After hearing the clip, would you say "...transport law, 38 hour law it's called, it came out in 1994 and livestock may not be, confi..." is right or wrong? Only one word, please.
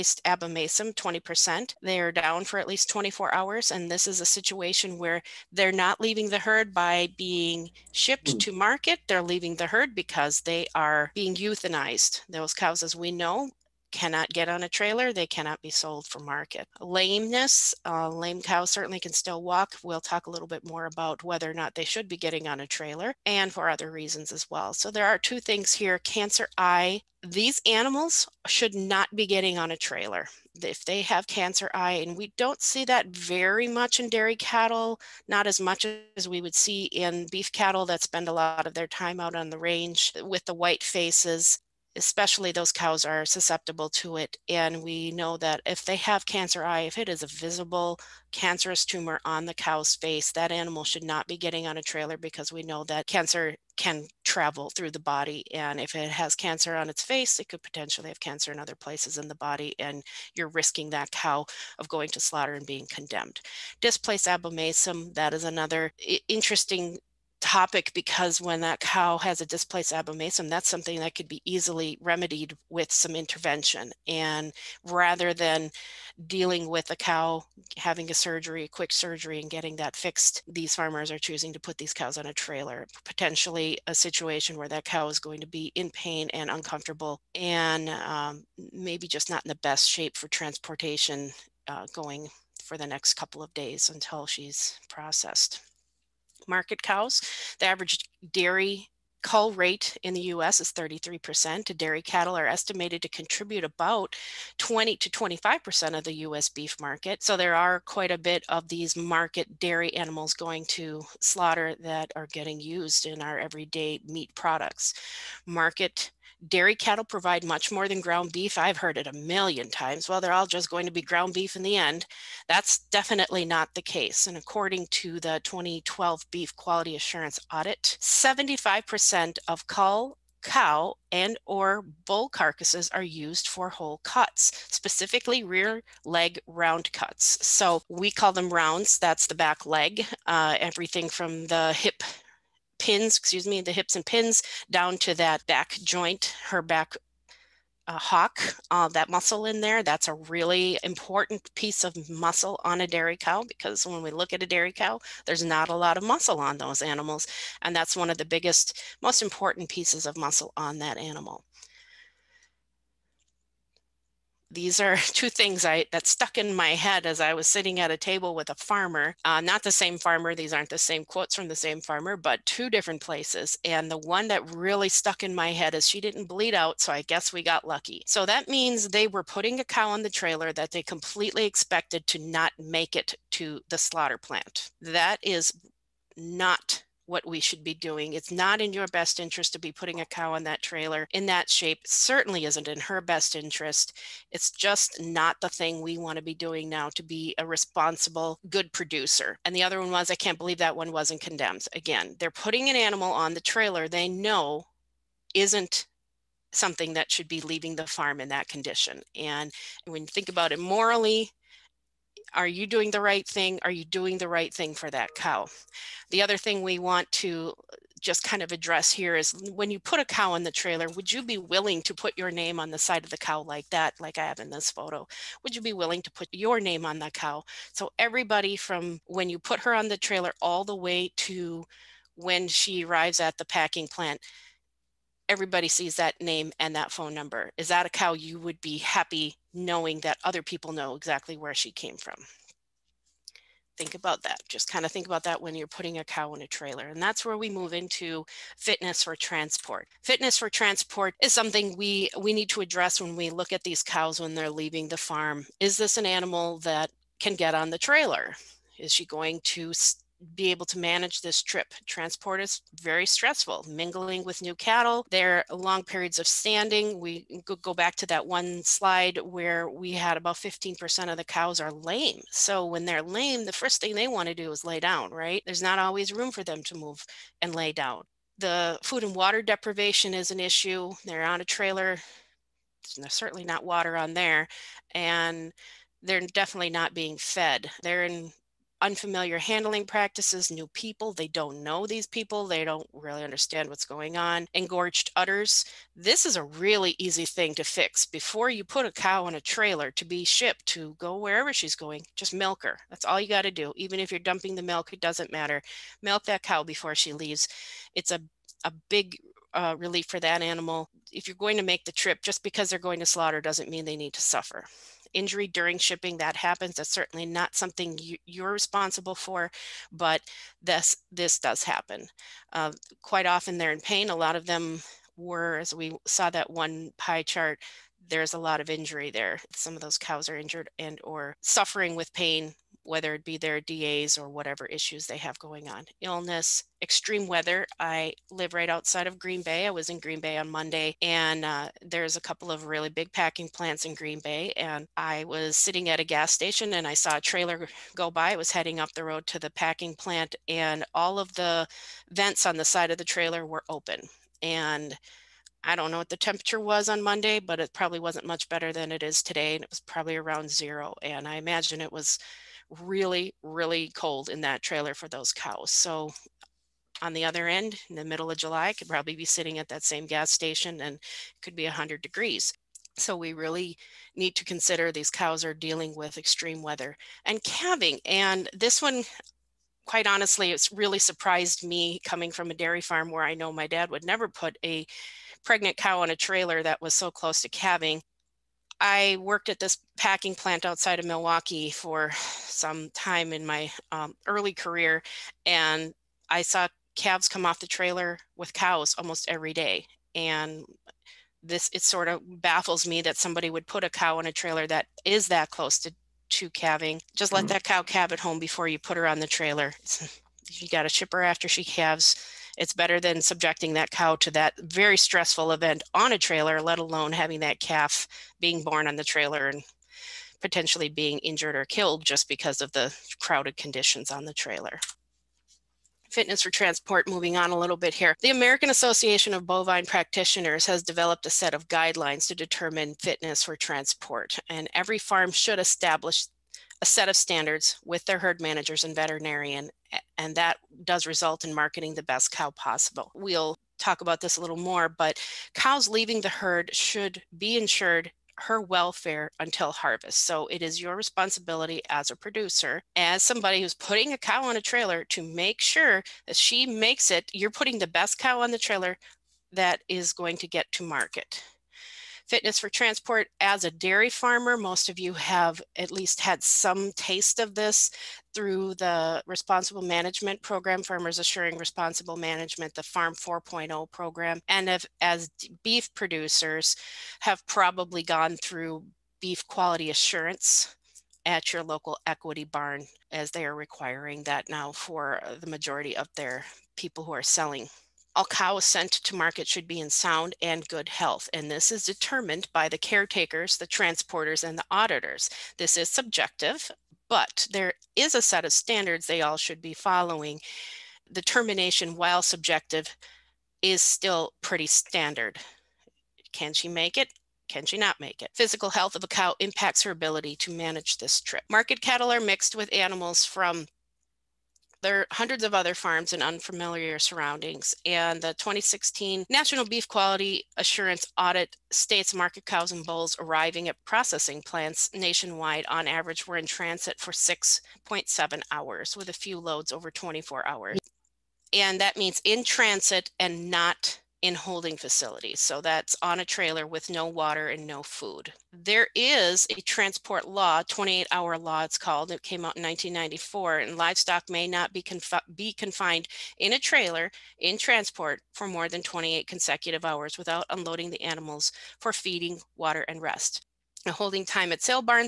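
wrong.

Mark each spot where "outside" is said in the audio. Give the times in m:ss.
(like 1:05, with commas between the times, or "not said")
5:38, 6:30.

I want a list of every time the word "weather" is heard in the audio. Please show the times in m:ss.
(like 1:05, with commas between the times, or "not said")
5:37, 6:16.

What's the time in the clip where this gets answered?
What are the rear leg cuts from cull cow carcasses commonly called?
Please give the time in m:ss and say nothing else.
2:18.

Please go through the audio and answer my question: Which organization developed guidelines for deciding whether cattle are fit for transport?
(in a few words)
American Association of Bovine Practitioners.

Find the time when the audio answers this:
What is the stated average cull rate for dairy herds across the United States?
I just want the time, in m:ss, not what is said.
1:40.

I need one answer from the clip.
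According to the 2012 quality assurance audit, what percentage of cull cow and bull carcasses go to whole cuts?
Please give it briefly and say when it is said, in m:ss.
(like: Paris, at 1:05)
75%, at 2:08.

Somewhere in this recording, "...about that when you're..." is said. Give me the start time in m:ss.
4:05.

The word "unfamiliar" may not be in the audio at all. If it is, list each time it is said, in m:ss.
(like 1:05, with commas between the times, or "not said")
4:48, 8:36.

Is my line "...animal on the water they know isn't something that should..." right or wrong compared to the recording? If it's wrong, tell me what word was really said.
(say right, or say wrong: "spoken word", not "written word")
wrong: "trailer", not "water".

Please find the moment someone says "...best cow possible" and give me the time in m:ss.
7:22.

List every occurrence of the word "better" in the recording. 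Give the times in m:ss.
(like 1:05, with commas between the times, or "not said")
5:58, 6:52.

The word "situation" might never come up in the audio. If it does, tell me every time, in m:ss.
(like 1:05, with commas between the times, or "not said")
0:04, 1:23.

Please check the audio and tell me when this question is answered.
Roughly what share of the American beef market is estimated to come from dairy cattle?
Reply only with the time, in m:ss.
1:44.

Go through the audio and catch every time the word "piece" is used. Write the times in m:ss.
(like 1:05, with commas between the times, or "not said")
2:31, 2:39.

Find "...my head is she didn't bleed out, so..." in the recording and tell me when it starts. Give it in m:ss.
2:55.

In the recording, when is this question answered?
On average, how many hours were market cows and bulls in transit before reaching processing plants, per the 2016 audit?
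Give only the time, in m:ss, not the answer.
8:47.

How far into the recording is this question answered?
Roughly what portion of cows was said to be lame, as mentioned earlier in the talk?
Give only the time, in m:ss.
4:30.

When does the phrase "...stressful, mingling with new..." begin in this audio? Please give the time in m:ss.
4:23.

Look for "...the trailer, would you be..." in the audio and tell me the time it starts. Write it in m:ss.
3:40.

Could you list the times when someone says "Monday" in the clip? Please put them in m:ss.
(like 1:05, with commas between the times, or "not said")
5:40, 5:57.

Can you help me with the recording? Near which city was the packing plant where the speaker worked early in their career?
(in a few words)
Milwaukee.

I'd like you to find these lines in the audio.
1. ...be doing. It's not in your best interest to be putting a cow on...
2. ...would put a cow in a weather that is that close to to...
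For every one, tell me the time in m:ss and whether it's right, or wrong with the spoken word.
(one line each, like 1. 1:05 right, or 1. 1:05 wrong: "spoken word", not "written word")
1. 3:07 right
2. 6:43 wrong: "trailer", not "weather".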